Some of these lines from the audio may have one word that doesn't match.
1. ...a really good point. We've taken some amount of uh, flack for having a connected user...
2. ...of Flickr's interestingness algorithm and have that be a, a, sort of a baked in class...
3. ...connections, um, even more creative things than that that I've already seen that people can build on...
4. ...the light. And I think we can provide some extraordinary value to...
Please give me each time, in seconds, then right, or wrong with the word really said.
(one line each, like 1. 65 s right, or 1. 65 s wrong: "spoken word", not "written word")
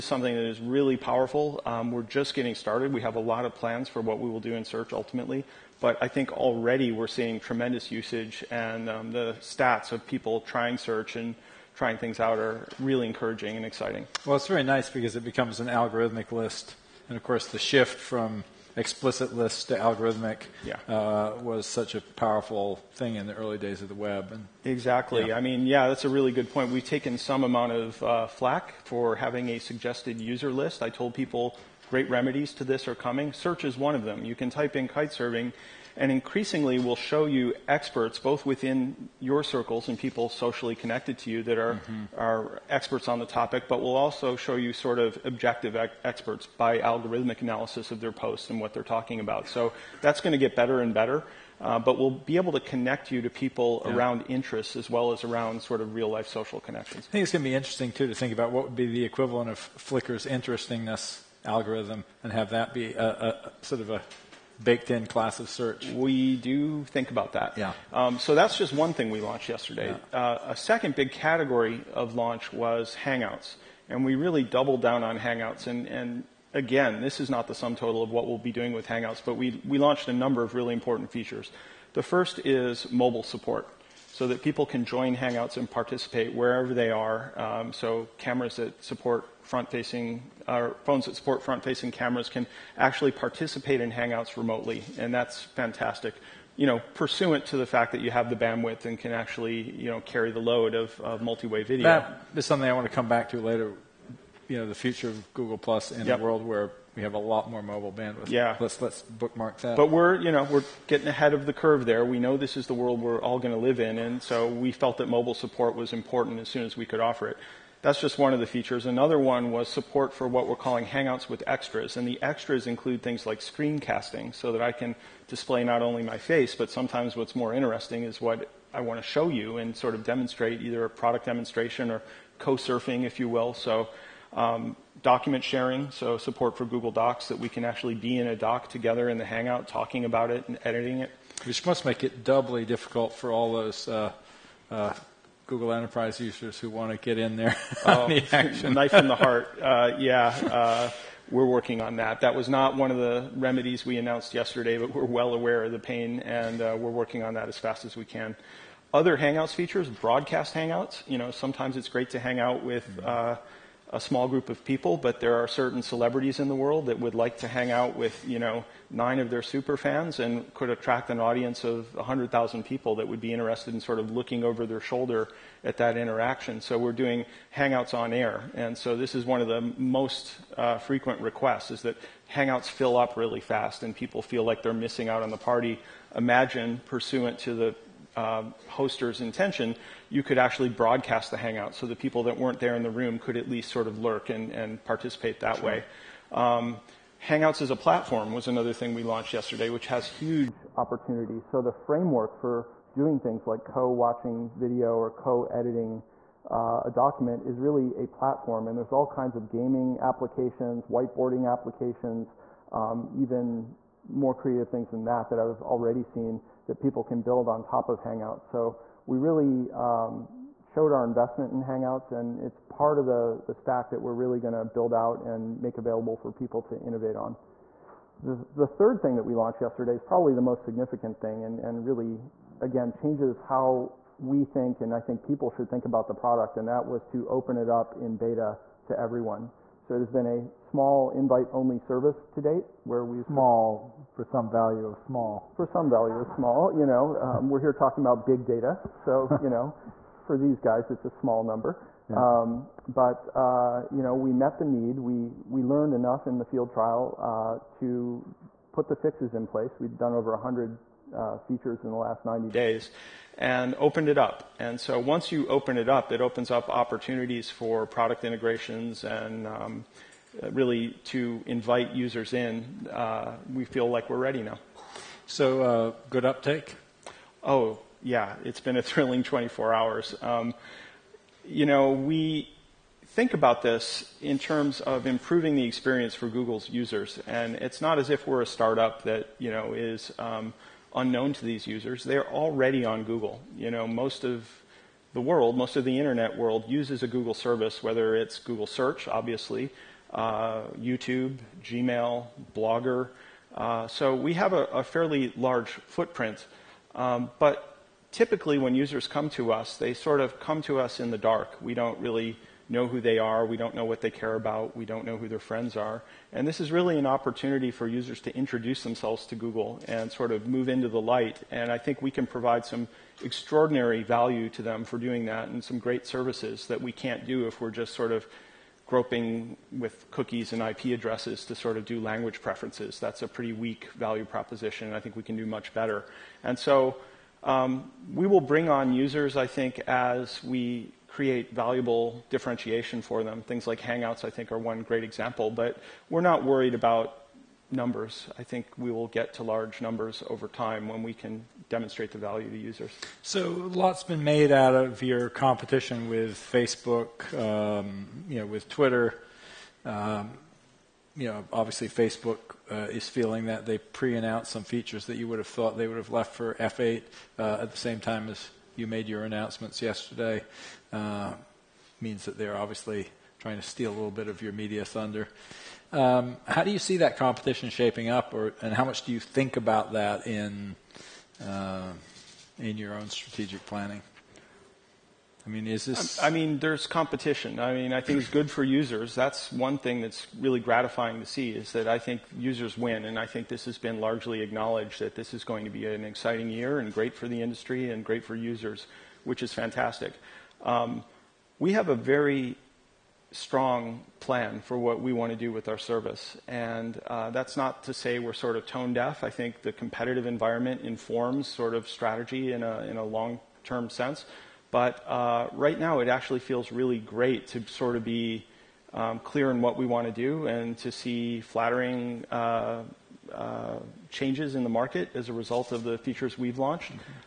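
1. 26 s wrong: "suggested", not "connected"
2. 59 s right
3. 211 s wrong: "applications", not "connections"
4. 320 s right.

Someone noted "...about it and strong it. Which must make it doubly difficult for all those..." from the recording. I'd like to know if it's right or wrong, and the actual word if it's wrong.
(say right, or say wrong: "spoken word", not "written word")
wrong: "editing", not "strong".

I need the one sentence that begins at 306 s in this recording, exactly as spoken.
Um, but typically, when users come to us, they sort of come to us in the dark.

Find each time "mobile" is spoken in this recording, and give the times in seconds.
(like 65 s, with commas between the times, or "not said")
82 s, 107 s, 115 s.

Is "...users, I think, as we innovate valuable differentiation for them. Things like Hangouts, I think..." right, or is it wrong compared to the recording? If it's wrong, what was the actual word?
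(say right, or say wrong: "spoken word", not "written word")
wrong: "create", not "innovate".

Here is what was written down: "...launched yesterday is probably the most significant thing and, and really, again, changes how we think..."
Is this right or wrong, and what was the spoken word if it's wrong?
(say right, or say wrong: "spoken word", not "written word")
right.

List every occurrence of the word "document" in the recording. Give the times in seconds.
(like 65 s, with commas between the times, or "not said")
135 s, 206 s.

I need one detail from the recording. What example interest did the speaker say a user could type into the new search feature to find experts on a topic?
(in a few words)
Kite surfing.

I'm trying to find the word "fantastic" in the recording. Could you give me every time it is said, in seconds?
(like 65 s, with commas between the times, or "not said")
95 s, 399 s.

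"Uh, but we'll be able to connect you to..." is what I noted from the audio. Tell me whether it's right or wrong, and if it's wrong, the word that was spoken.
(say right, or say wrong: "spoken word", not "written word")
right.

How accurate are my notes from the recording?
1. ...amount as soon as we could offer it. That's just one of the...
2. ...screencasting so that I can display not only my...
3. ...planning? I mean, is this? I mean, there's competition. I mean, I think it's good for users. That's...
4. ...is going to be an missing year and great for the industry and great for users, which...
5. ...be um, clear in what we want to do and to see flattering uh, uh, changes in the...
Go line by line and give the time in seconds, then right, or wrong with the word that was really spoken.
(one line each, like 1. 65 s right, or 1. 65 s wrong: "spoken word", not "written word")
1. 115 s wrong: "important", not "amount"
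2. 123 s right
3. 383 s right
4. 395 s wrong: "exciting", not "missing"
5. 418 s right.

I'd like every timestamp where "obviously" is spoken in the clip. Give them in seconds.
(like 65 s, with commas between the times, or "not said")
299 s, 361 s, 372 s.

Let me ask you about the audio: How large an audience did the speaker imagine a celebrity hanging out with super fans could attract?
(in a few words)
100,000 people.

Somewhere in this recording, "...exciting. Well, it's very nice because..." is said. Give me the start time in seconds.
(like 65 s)
13 s.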